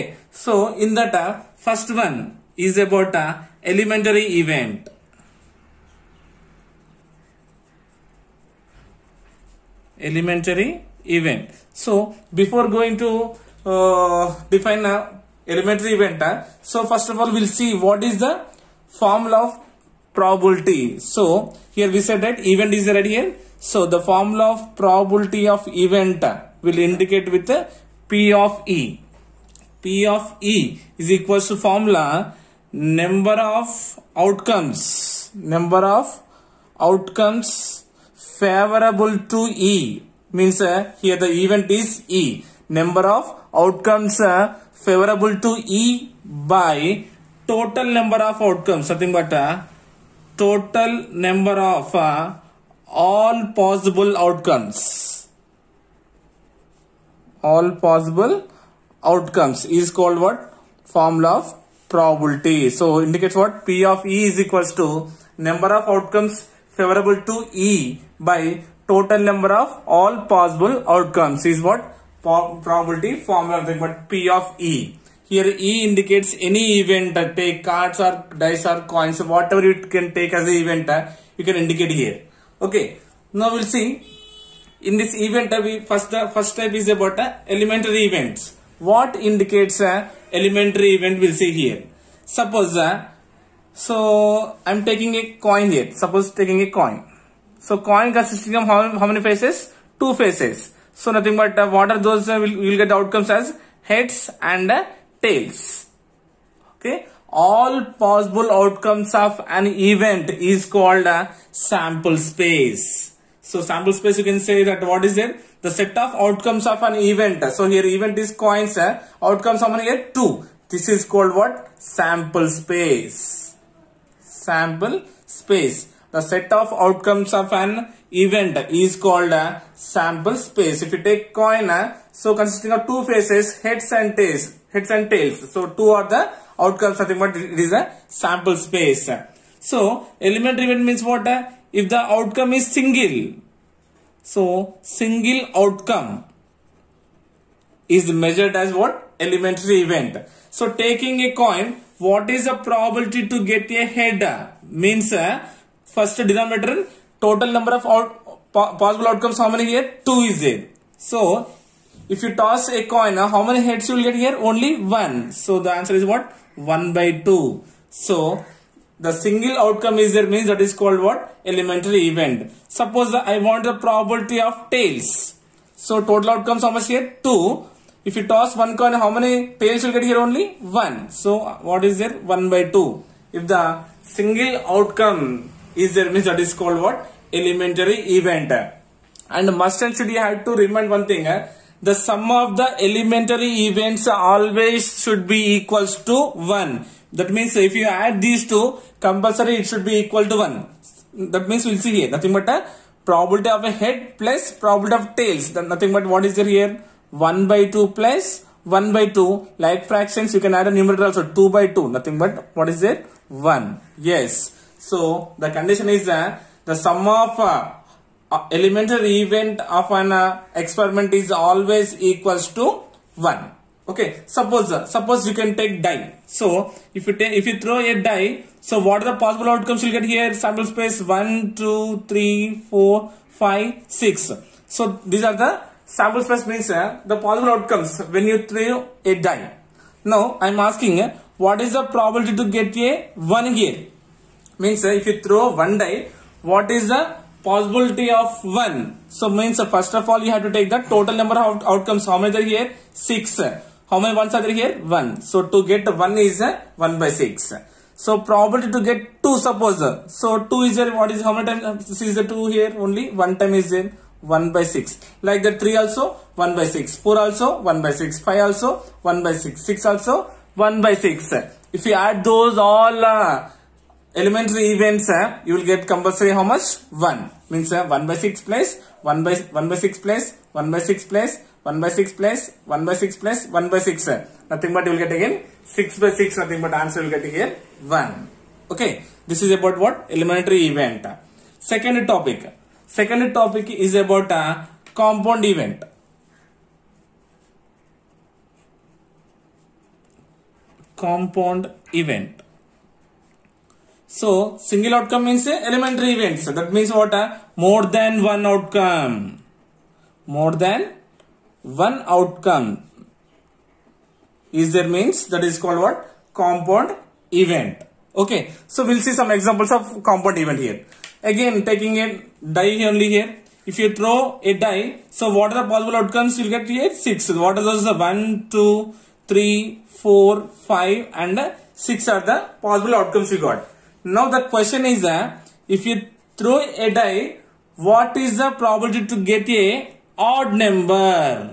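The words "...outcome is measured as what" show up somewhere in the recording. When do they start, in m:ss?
2:25.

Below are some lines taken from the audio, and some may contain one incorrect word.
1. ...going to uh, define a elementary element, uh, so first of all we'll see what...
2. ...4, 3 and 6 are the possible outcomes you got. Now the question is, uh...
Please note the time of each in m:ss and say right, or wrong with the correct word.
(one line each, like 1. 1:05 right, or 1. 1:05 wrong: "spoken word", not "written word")
1. 0:12 wrong: "event", not "element"
2. 5:29 wrong: "5", not "3".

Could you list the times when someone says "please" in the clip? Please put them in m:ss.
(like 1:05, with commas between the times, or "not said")
not said.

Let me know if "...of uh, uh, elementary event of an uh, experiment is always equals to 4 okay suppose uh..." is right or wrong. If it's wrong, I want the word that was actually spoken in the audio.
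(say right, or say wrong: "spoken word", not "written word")
wrong: "1", not "4".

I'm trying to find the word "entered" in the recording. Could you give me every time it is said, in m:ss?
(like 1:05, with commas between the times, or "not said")
not said.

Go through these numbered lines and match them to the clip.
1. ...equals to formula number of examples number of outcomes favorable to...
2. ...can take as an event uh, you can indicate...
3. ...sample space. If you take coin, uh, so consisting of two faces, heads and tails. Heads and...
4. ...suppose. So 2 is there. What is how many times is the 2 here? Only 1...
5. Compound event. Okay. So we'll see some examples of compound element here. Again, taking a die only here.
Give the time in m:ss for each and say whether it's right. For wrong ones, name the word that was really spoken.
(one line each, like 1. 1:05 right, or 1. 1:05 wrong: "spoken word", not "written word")
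1. 0:31 wrong: "outcomes", not "examples"
2. 1:19 right
3. 2:09 right
4. 4:19 right
5. 5:16 wrong: "event", not "element".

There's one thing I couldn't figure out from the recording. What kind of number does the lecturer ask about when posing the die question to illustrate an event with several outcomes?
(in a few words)
Odd number.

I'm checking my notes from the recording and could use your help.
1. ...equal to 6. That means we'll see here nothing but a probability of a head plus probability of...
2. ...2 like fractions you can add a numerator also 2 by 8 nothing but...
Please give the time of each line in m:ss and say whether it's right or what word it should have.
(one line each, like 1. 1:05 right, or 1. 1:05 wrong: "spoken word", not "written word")
1. 3:19 wrong: "1", not "6"
2. 3:29 wrong: "2", not "8".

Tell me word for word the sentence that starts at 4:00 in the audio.
Now I am asking uh, what is the probability to get a 1 here?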